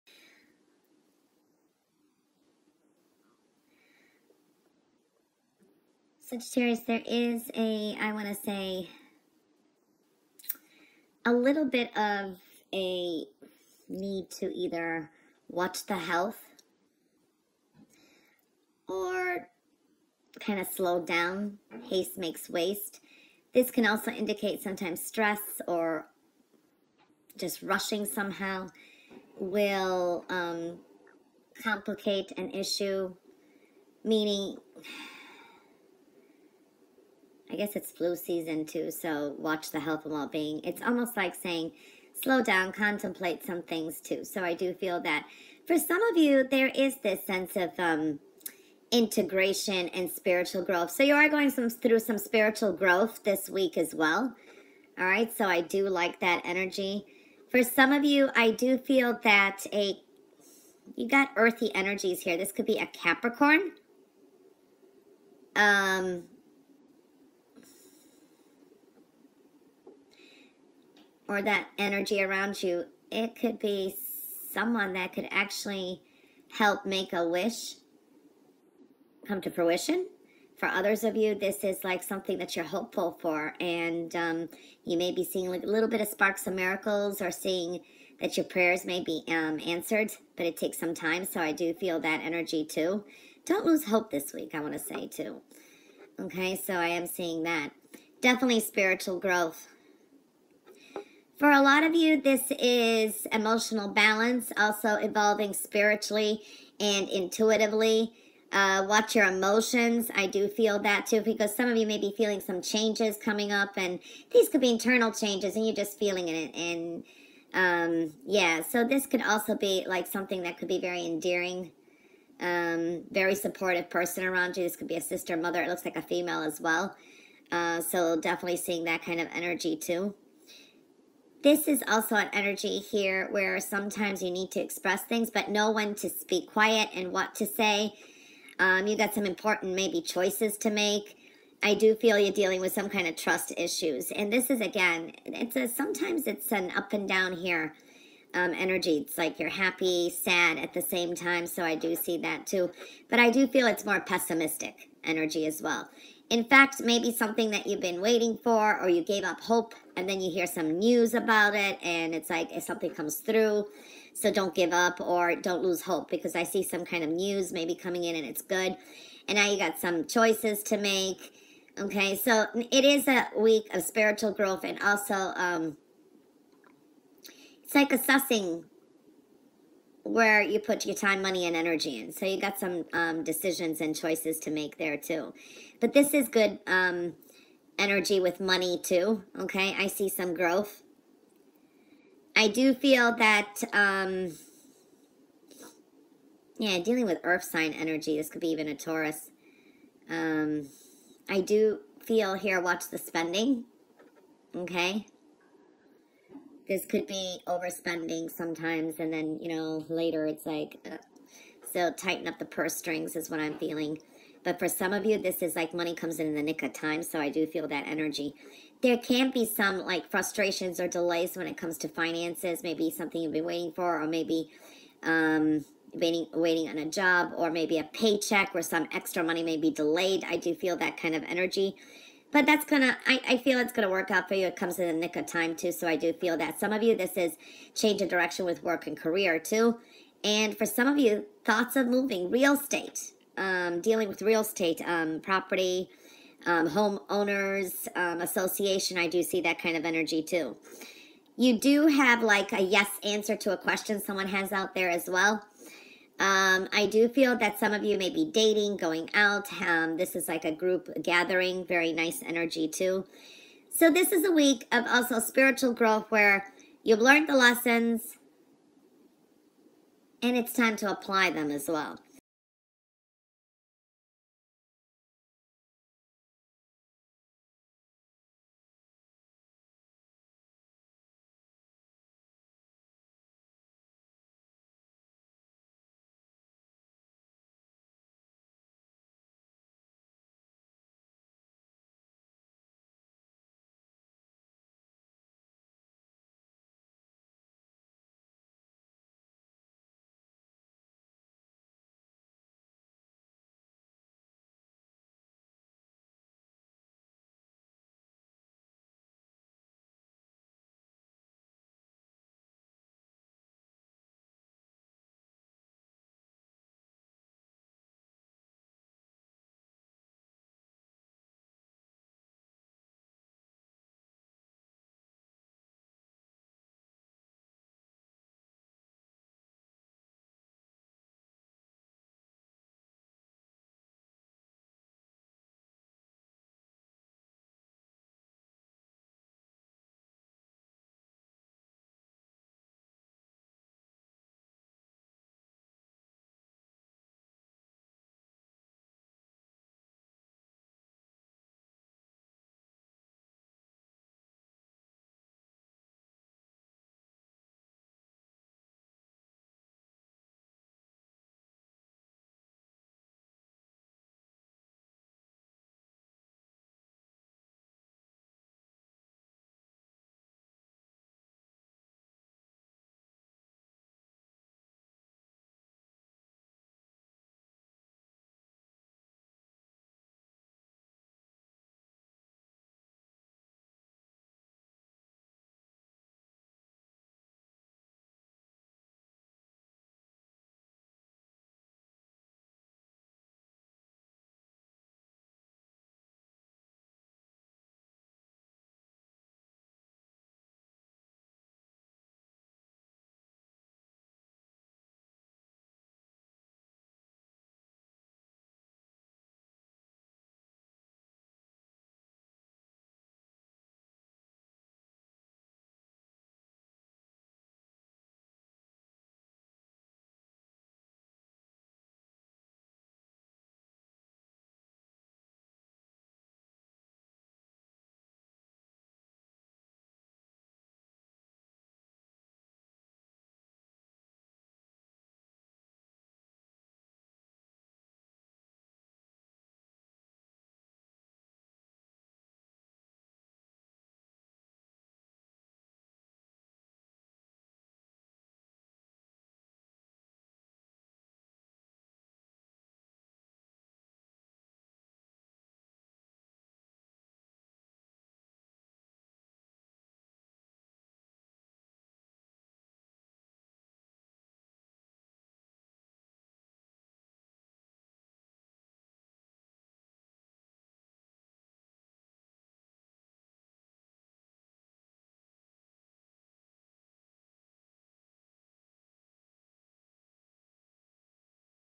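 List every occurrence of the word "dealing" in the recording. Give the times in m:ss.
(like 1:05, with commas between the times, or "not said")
2:22, 3:16, 4:03.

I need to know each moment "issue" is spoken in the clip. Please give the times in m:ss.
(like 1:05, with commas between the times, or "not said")
0:32, 2:23.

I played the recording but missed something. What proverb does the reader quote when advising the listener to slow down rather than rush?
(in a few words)
Haste makes waste.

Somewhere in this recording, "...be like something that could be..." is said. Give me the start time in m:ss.
1:59.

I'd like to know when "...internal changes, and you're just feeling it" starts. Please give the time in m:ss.
1:54.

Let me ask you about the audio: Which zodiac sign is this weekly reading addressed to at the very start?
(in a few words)
Sagittarius.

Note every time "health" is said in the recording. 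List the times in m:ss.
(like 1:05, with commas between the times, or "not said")
0:15, 0:39.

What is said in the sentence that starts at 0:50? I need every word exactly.
So you are going some, through some spiritual growth this week as well.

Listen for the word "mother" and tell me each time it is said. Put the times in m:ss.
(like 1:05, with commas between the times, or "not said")
2:05.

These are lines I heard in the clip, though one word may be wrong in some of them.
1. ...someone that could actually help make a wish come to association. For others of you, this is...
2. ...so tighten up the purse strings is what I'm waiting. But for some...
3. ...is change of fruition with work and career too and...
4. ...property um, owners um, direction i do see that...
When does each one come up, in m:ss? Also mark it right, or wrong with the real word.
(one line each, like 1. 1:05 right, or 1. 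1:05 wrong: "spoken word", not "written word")
1. 1:14 wrong: "fruition", not "association"
2. 3:31 wrong: "feeling", not "waiting"
3. 3:57 wrong: "direction", not "fruition"
4. 4:05 wrong: "association", not "direction".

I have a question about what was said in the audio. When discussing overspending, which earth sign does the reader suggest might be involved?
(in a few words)
Taurus.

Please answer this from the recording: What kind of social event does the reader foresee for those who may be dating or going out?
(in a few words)
A group gathering.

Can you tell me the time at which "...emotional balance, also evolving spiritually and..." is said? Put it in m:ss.
1:43.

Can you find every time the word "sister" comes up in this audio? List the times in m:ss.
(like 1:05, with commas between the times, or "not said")
2:05.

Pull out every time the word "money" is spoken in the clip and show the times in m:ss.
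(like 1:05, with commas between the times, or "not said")
3:01, 3:08, 3:35, 3:49.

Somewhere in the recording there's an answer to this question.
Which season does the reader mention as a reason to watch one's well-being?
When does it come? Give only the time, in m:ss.
0:37.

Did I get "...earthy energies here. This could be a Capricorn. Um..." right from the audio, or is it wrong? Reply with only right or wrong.
right.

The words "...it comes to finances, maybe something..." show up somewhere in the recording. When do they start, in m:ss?
3:41.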